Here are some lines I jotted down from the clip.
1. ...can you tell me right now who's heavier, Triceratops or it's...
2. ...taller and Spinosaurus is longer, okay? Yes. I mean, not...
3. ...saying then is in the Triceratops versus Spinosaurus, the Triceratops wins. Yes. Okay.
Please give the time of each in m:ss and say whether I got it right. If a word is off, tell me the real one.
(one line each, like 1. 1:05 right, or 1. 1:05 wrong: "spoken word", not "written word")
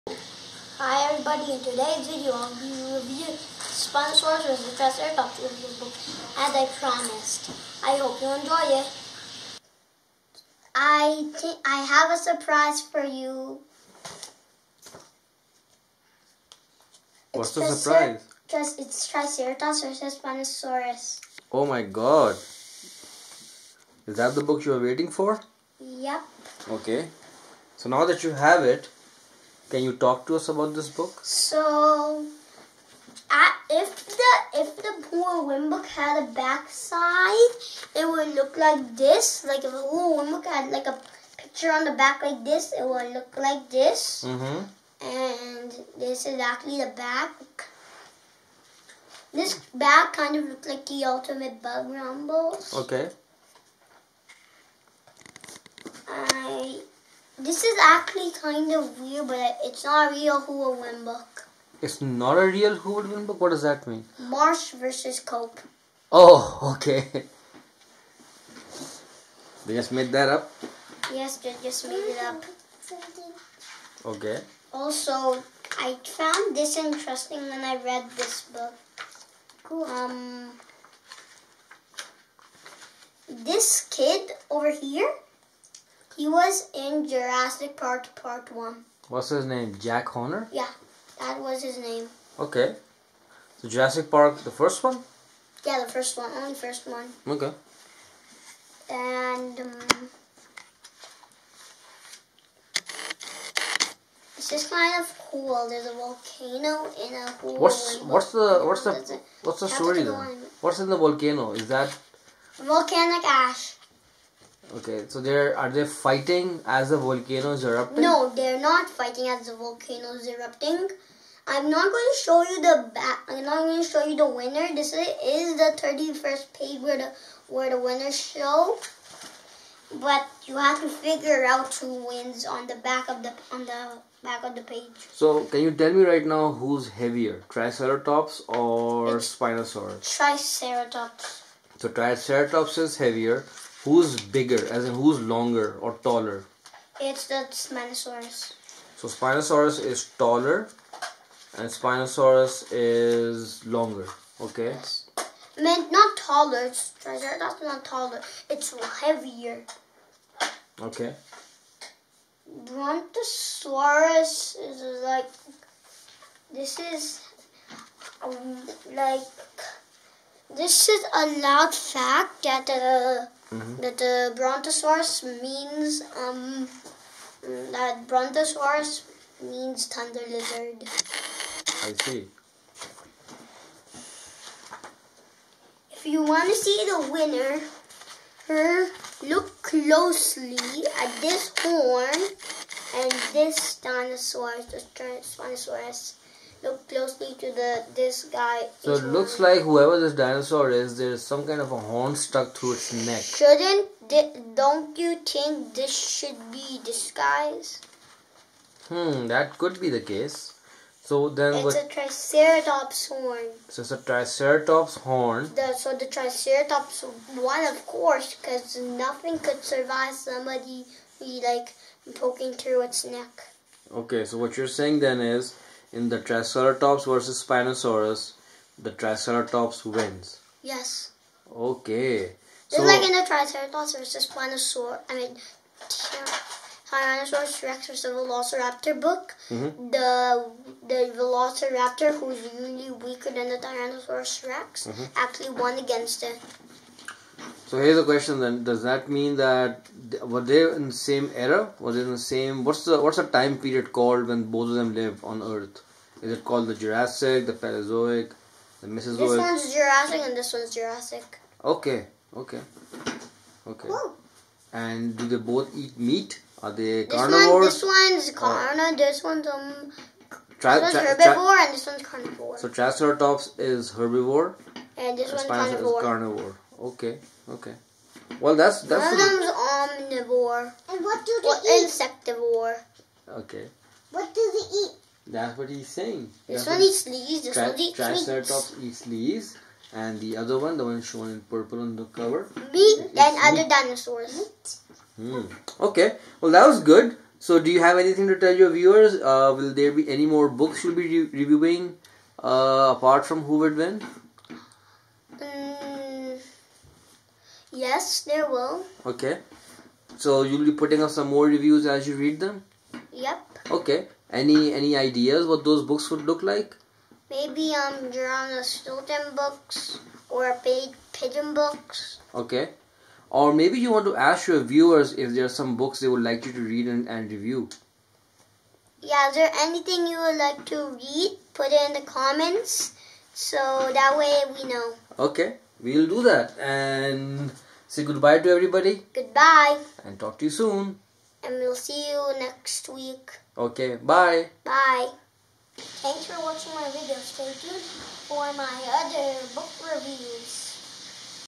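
1. 2:15 right
2. 2:30 right
3. 3:44 right.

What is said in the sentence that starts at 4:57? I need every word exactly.
So, do you have anything to tell your viewers?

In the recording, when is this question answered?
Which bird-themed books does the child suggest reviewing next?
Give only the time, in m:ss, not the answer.
5:20.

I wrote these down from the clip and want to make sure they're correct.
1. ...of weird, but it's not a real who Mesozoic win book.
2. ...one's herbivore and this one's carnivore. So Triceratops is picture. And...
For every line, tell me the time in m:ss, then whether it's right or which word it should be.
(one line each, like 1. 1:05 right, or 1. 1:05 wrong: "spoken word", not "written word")
1. 0:58 wrong: "Would", not "Mesozoic"
2. 4:30 wrong: "herbivore", not "picture".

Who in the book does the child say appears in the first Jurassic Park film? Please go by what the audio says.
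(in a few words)
Jack Horner.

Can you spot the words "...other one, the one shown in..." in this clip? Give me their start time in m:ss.
4:50.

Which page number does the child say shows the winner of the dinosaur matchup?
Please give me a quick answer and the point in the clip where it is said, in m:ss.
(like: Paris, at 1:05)
31, at 2:05.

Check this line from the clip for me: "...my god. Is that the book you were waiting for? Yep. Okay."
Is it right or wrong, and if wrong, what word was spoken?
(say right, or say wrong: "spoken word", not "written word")
right.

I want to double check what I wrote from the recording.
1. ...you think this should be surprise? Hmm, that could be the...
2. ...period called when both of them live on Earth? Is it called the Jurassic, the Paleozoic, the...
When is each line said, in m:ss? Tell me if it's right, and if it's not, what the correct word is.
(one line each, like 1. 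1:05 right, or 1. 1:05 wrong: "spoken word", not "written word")
1. 3:24 wrong: "disguise", not "surprise"
2. 4:13 right.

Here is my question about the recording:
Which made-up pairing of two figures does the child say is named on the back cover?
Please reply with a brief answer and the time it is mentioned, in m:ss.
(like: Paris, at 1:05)
Marsh versus Cope, at 1:04.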